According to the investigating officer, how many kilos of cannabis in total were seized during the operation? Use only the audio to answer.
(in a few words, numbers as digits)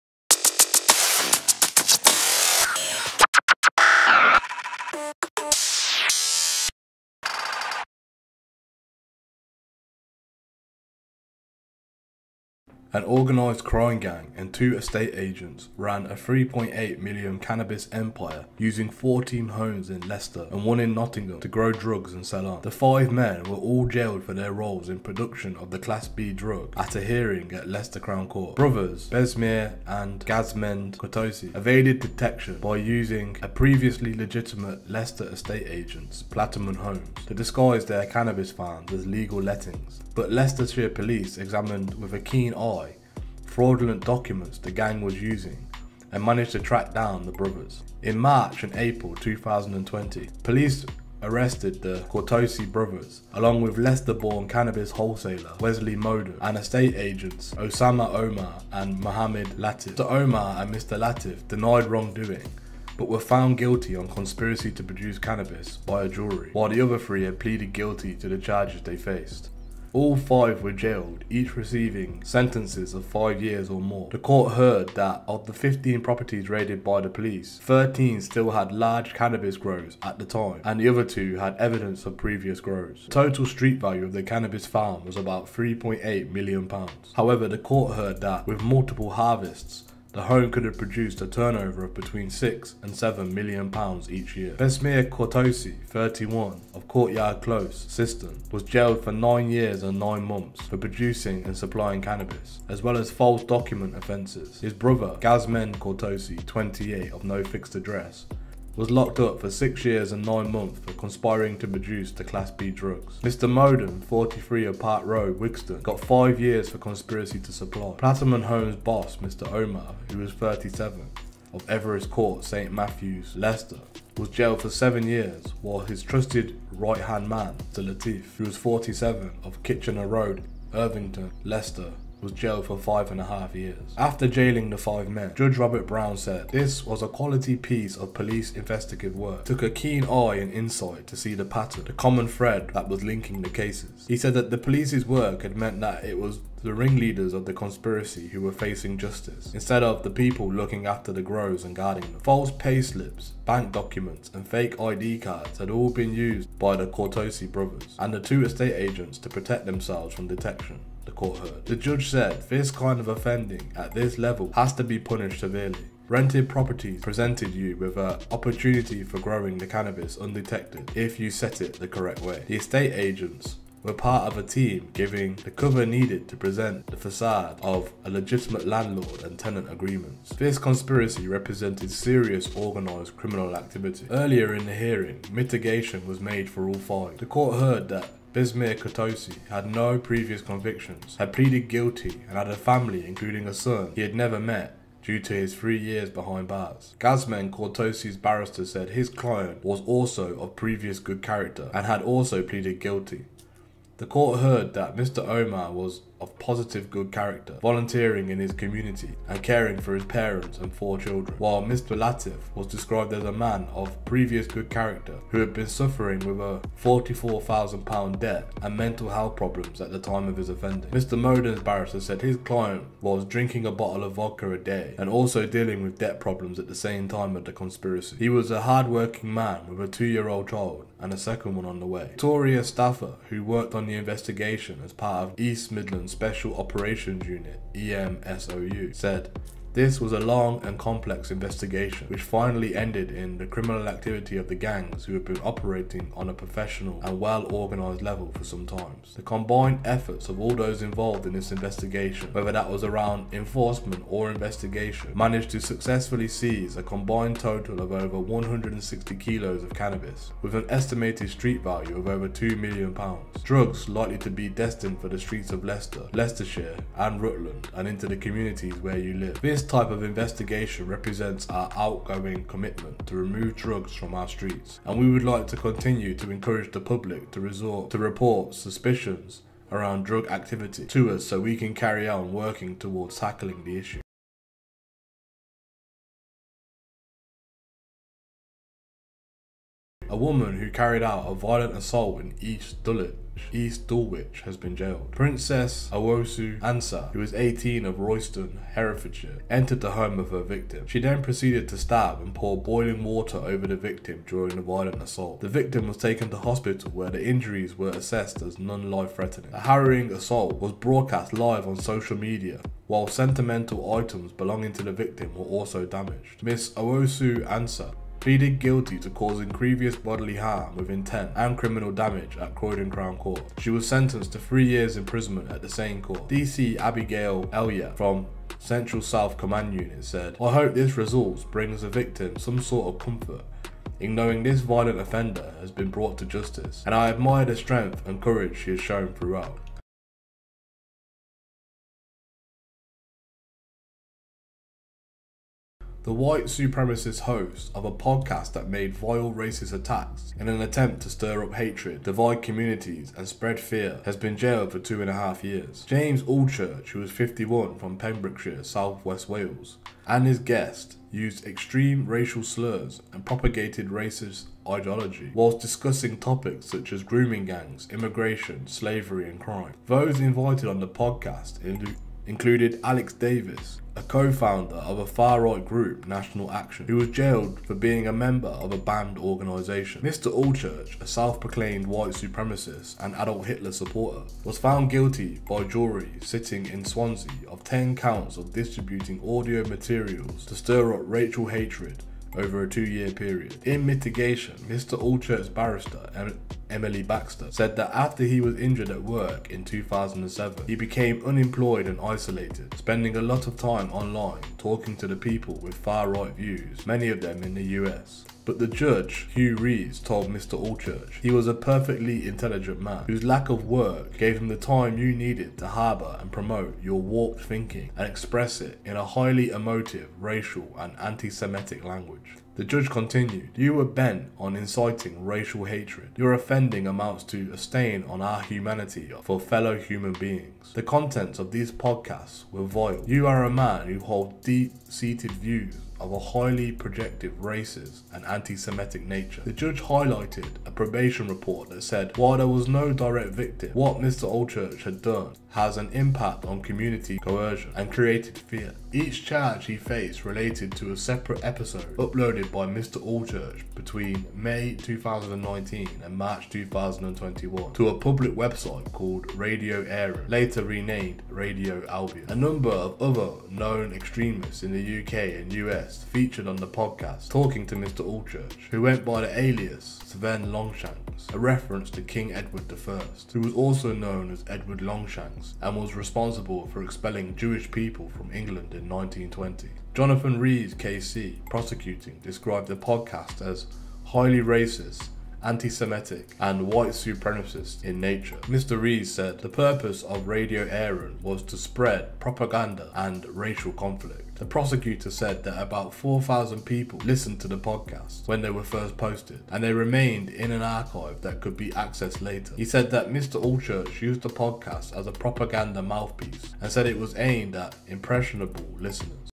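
over 160 kilos.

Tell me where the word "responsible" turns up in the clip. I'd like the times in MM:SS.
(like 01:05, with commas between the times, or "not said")
07:55.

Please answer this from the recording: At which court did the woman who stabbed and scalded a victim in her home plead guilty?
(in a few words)
Croydon Crown Court.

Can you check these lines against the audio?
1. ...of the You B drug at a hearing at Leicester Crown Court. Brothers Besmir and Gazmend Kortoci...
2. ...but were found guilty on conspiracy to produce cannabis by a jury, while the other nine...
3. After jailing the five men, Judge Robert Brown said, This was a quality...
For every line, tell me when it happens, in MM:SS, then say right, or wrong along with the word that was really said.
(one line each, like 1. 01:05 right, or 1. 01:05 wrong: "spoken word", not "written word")
1. 00:25 wrong: "Class", not "You"
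2. 01:02 wrong: "three", not "nine"
3. 02:13 right.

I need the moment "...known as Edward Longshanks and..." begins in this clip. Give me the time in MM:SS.
07:53.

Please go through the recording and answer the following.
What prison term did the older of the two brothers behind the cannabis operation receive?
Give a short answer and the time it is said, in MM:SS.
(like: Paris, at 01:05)
9 years and 9 months, at 01:39.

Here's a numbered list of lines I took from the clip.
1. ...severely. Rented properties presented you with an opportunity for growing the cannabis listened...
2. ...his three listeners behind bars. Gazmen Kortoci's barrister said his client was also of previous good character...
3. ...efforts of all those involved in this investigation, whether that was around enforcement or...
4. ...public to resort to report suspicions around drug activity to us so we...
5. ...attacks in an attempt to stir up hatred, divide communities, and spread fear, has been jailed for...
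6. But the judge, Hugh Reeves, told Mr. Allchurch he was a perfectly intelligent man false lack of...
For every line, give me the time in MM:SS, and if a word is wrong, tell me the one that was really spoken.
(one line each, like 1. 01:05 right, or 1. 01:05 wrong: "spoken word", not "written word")
1. 02:45 wrong: "undetected", not "listened"
2. 03:15 wrong: "years", not "listeners"
3. 04:09 right
4. 04:36 right
5. 05:49 right
6. 06:48 wrong: "whose", not "false".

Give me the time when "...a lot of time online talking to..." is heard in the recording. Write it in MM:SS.
06:43.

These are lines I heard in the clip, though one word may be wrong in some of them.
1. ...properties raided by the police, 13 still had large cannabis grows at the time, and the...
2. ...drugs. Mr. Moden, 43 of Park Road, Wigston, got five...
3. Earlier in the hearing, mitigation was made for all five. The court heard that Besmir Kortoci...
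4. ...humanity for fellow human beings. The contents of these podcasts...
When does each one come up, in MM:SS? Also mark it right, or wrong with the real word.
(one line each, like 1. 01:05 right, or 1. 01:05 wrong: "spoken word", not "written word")
1. 01:15 right
2. 01:52 right
3. 03:04 right
4. 07:08 right.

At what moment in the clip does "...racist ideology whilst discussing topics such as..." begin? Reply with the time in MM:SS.
06:03.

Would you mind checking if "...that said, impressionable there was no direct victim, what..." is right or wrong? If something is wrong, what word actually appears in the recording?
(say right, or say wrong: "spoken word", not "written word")
wrong: "while", not "impressionable".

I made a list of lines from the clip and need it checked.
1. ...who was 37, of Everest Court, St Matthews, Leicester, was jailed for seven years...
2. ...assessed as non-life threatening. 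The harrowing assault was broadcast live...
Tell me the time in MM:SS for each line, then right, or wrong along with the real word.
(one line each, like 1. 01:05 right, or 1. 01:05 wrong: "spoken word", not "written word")
1. 02:00 right
2. 05:07 right.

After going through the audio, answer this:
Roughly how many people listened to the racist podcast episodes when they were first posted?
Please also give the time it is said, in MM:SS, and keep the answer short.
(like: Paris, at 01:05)
4,000, at 08:15.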